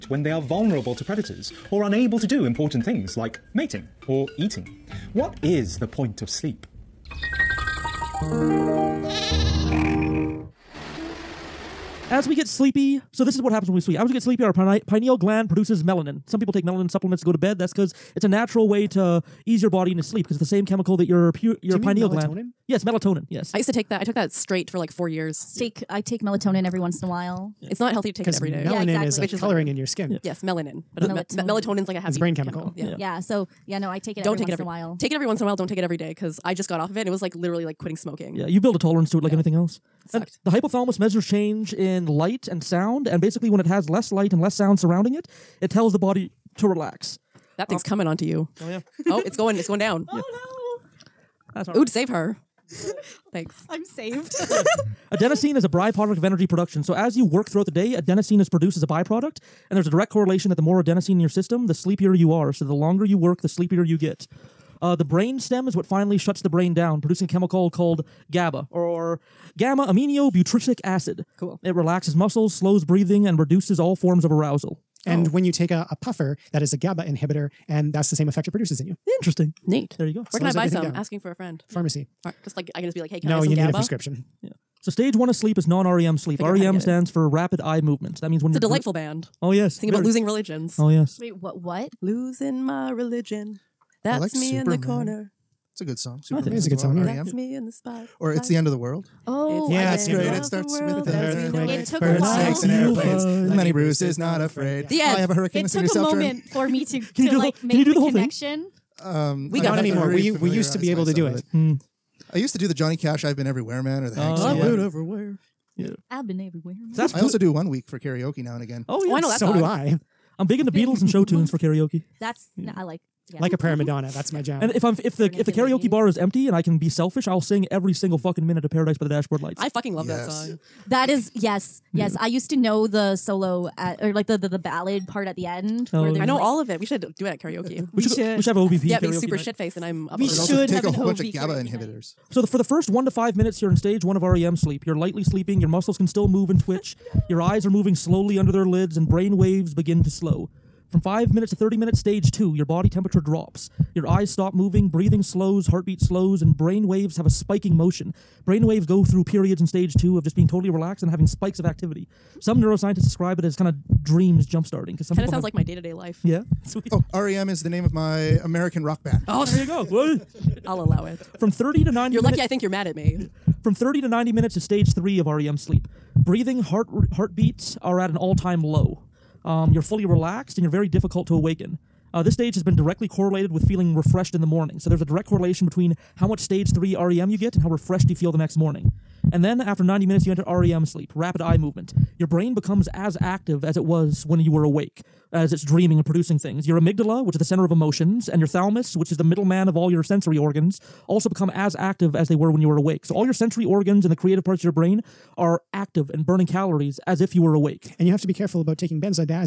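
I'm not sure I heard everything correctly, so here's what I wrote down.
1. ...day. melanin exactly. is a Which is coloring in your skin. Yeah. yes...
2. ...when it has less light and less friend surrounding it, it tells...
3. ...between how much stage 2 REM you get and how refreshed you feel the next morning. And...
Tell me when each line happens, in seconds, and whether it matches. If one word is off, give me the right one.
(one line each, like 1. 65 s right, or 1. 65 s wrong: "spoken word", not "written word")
1. 28 s right
2. 43 s wrong: "sound", not "friend"
3. 185 s wrong: "3", not "2".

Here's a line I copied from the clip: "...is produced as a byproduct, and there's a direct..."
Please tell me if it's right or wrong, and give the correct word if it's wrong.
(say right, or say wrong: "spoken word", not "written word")
right.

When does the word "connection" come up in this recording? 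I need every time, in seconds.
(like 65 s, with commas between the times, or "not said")
108 s.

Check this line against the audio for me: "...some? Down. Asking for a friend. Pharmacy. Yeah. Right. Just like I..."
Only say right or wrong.
right.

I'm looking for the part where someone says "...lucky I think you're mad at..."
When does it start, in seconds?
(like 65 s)
172 s.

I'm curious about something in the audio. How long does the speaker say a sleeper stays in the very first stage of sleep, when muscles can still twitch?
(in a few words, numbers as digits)
1 to 5 minutes.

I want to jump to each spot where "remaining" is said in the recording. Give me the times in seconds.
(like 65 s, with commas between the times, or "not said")
not said.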